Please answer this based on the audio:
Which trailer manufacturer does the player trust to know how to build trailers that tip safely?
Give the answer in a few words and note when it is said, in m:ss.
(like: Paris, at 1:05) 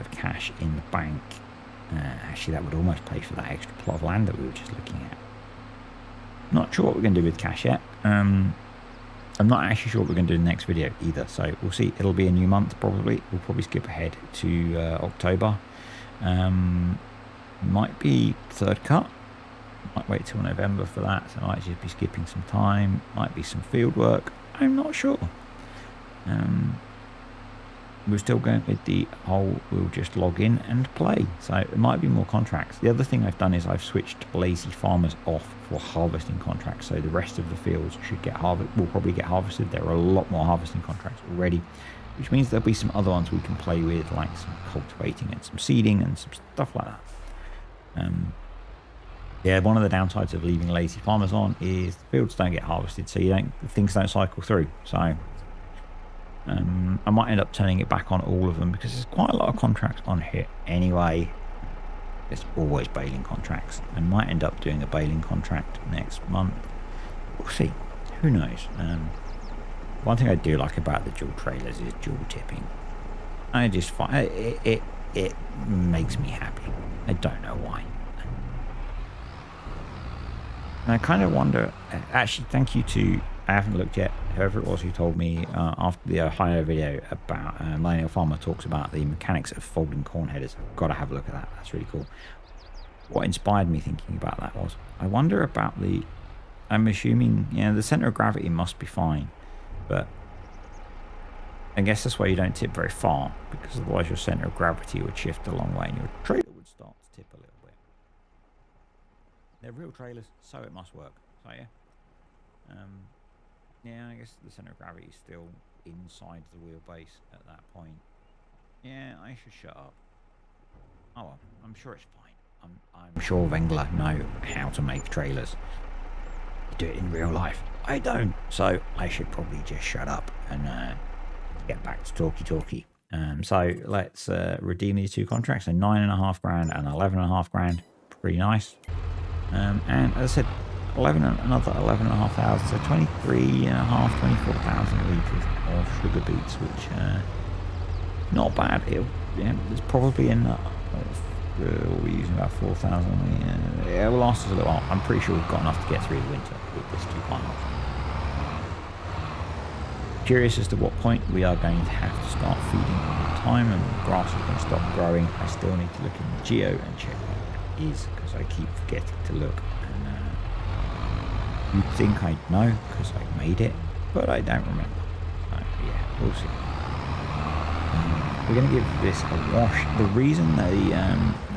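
Wengler, at 2:03.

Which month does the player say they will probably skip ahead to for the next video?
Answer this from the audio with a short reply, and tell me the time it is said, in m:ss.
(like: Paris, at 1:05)
October, at 0:15.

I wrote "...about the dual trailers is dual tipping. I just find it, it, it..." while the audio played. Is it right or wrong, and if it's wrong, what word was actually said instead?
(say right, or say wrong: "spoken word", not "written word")
right.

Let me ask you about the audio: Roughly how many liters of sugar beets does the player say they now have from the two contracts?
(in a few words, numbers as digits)
24,000 liters.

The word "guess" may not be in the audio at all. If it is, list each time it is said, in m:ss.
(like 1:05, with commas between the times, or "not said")
1:41, 1:54.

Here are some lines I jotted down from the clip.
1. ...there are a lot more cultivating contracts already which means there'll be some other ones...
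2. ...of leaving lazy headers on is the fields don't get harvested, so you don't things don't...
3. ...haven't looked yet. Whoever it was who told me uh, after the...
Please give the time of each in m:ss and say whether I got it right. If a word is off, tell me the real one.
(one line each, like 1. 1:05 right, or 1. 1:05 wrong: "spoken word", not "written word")
1. 0:39 wrong: "harvesting", not "cultivating"
2. 0:50 wrong: "farmers", not "headers"
3. 1:23 right.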